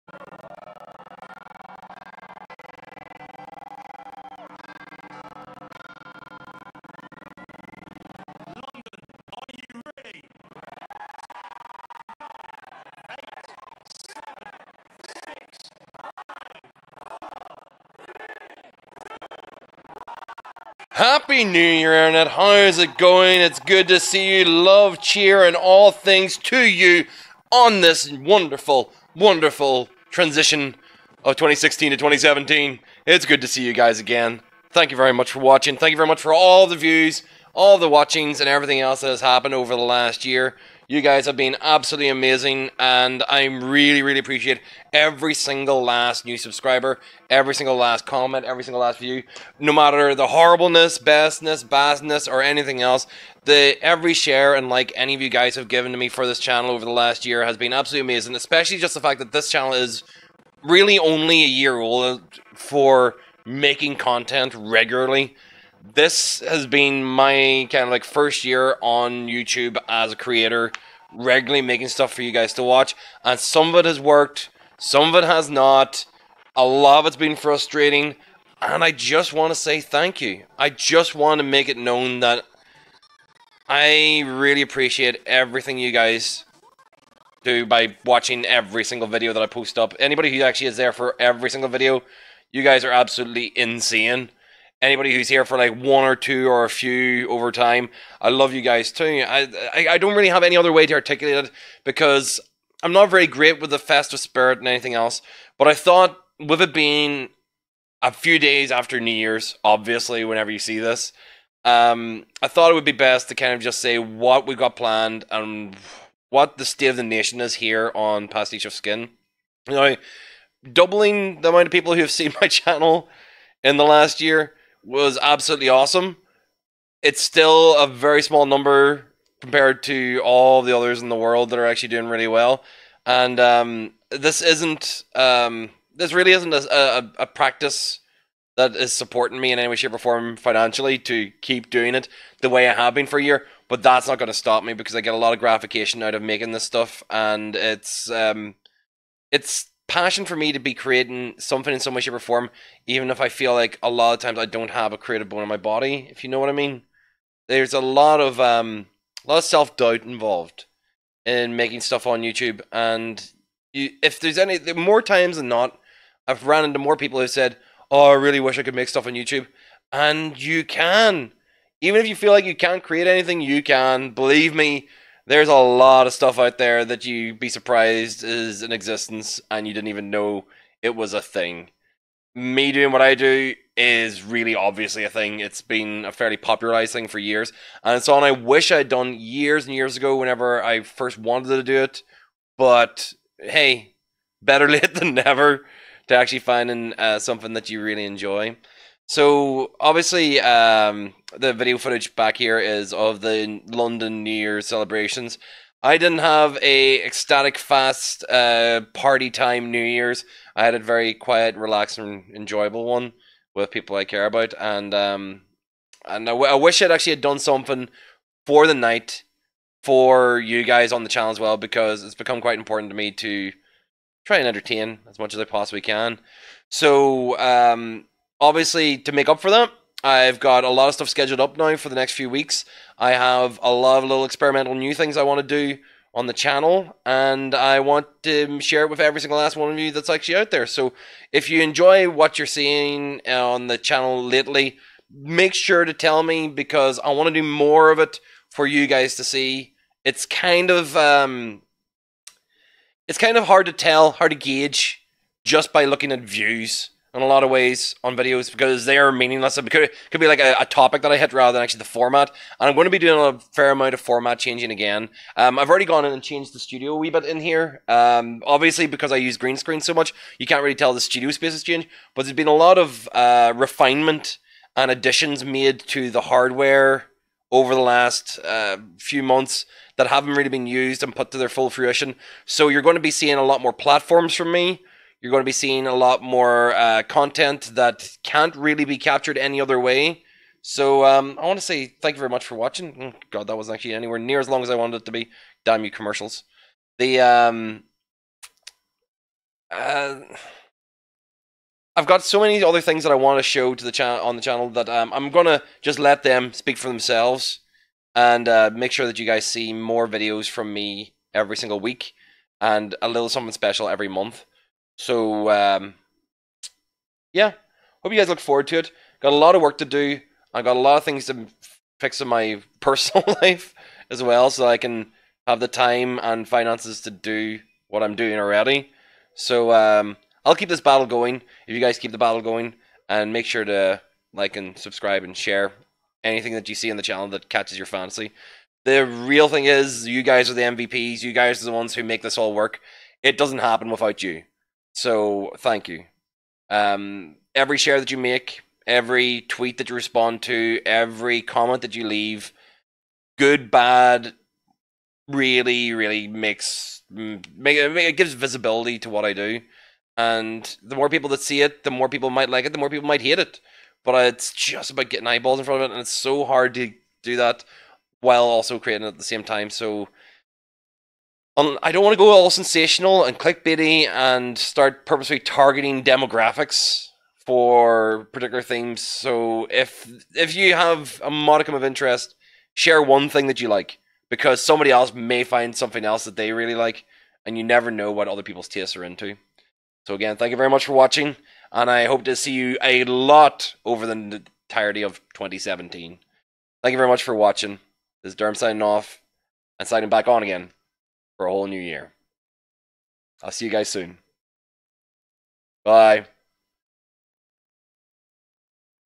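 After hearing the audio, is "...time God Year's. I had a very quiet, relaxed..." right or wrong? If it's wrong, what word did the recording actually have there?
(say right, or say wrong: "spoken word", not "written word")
wrong: "New", not "God".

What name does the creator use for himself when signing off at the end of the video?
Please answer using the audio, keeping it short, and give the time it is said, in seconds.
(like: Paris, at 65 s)
Derm, at 398 s.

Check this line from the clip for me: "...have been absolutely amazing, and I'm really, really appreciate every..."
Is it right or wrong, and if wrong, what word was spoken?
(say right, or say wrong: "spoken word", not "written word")
right.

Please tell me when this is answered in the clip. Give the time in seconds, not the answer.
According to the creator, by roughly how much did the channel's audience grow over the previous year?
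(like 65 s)
120 s.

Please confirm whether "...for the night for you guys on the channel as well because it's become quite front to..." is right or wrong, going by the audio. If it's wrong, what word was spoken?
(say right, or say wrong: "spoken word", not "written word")
wrong: "important", not "front".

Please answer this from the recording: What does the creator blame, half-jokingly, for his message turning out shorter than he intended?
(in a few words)
Commercials.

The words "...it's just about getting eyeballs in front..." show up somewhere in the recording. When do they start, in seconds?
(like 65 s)
364 s.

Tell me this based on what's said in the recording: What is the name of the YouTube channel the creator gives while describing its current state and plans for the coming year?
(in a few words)
Pastiche of Skin.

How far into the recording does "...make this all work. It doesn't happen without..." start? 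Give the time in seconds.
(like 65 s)
342 s.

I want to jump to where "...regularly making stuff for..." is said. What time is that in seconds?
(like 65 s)
71 s.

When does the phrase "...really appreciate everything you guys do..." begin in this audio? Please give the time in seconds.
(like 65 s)
84 s.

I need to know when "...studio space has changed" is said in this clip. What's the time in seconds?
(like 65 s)
271 s.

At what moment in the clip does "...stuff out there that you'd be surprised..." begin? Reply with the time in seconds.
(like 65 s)
176 s.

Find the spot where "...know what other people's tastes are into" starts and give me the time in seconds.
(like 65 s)
387 s.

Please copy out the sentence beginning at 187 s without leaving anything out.
And it's something I wish I'd done years and years ago whenever I first wanted to do it.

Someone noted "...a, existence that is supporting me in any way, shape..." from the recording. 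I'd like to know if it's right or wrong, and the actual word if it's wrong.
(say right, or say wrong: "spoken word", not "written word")
wrong: "practice", not "existence".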